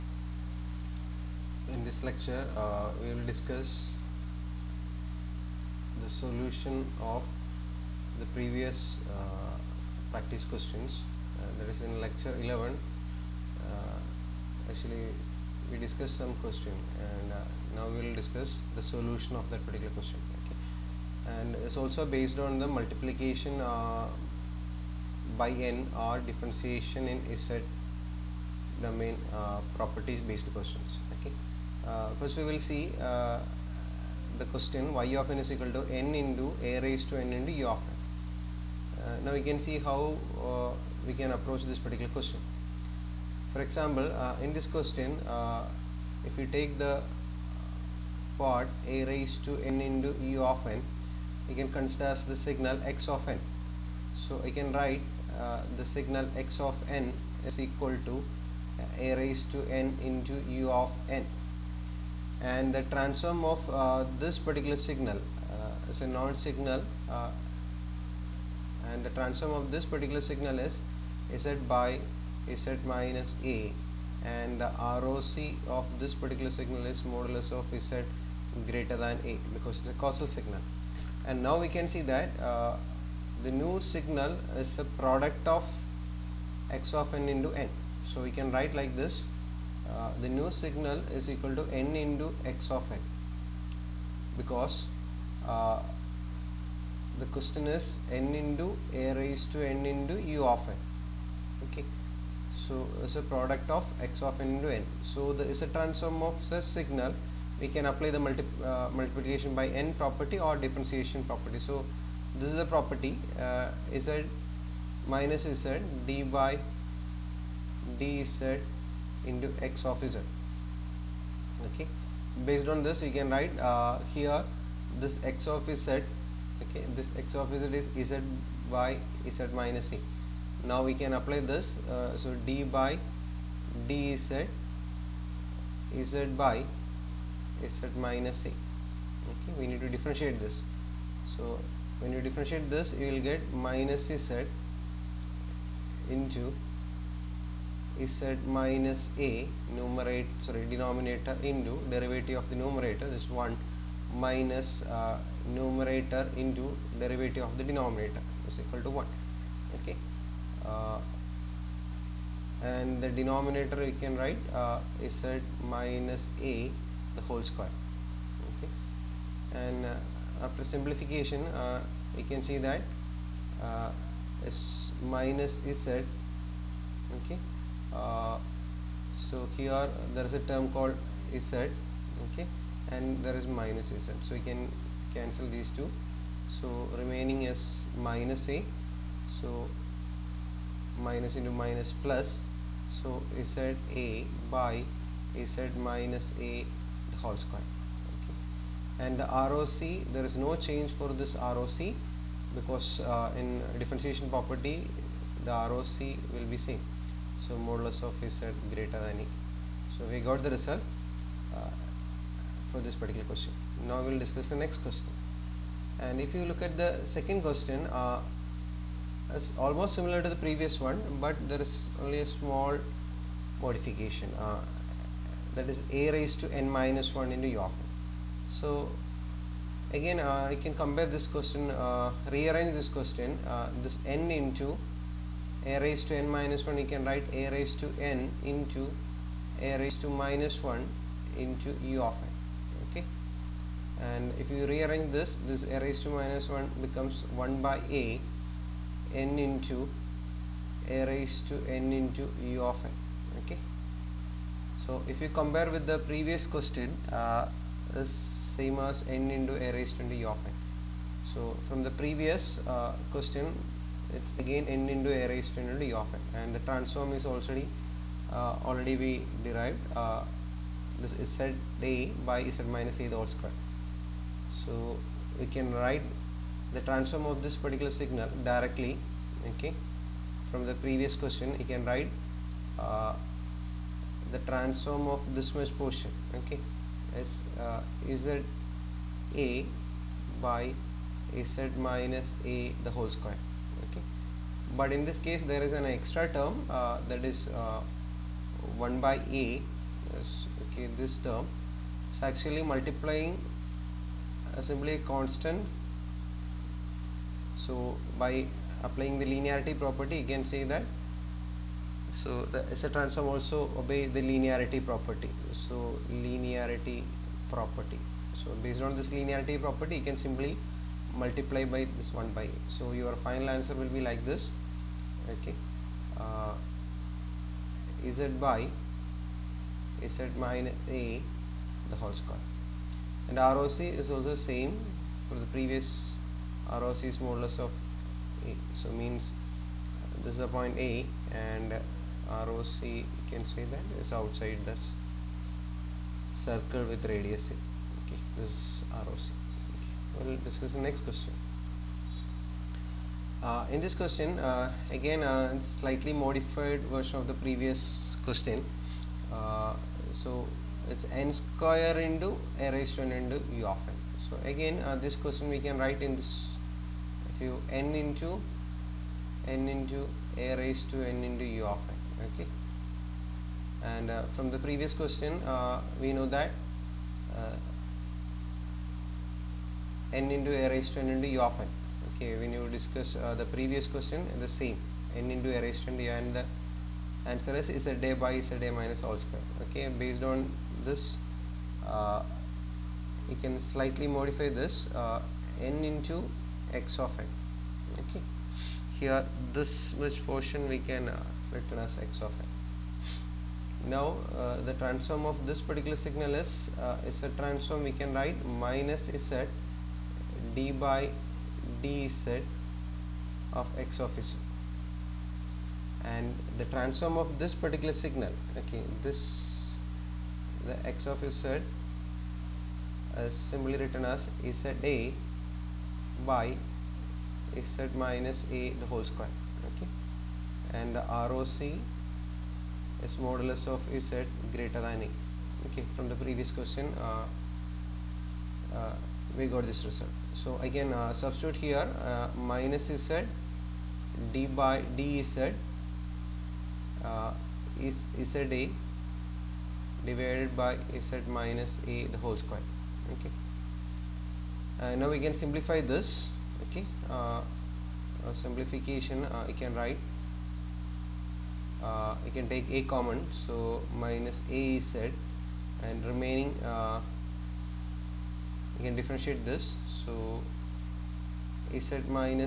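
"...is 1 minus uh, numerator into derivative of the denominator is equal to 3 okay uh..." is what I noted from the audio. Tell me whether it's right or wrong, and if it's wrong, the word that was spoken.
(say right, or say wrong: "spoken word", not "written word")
wrong: "1", not "3".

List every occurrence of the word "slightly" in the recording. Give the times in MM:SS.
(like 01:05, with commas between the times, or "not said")
05:55, 06:33.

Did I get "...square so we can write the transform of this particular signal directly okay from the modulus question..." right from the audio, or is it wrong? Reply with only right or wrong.
wrong.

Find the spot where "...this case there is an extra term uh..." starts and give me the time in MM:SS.
04:55.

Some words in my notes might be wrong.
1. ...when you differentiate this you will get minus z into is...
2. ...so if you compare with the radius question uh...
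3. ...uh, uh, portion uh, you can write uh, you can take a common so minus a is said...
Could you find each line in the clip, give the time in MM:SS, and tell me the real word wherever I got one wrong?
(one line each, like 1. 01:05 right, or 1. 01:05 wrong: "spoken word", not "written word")
1. 02:21 right
2. 04:14 wrong: "previous", not "radius"
3. 07:37 wrong: "simplification", not "portion".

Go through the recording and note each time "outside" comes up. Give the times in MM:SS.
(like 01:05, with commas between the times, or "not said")
05:44.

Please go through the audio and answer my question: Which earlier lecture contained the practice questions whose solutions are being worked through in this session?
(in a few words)
Lecture 11.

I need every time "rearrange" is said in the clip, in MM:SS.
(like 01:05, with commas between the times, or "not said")
03:52, 04:04.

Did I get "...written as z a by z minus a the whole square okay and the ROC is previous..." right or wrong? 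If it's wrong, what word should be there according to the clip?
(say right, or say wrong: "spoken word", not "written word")
wrong: "modulus", not "previous".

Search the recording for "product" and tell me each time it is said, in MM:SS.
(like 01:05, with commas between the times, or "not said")
01:25, 01:43.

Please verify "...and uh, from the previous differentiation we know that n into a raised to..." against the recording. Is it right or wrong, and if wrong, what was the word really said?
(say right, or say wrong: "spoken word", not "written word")
wrong: "question", not "differentiation".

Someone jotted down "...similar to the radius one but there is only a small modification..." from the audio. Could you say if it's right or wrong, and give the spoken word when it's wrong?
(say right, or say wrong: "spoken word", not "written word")
wrong: "previous", not "radius".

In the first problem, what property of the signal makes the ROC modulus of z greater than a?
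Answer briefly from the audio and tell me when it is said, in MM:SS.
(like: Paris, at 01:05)
causal signal, at 01:19.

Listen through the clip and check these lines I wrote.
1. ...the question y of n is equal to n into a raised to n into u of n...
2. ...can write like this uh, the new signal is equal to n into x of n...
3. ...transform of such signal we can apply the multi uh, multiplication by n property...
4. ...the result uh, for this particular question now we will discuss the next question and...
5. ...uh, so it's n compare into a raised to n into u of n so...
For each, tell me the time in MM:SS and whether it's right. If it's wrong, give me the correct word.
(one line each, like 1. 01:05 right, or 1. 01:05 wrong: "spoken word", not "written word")
1. 00:34 right
2. 01:28 right
3. 01:45 right
4. 03:30 right
5. 05:59 wrong: "square", not "compare".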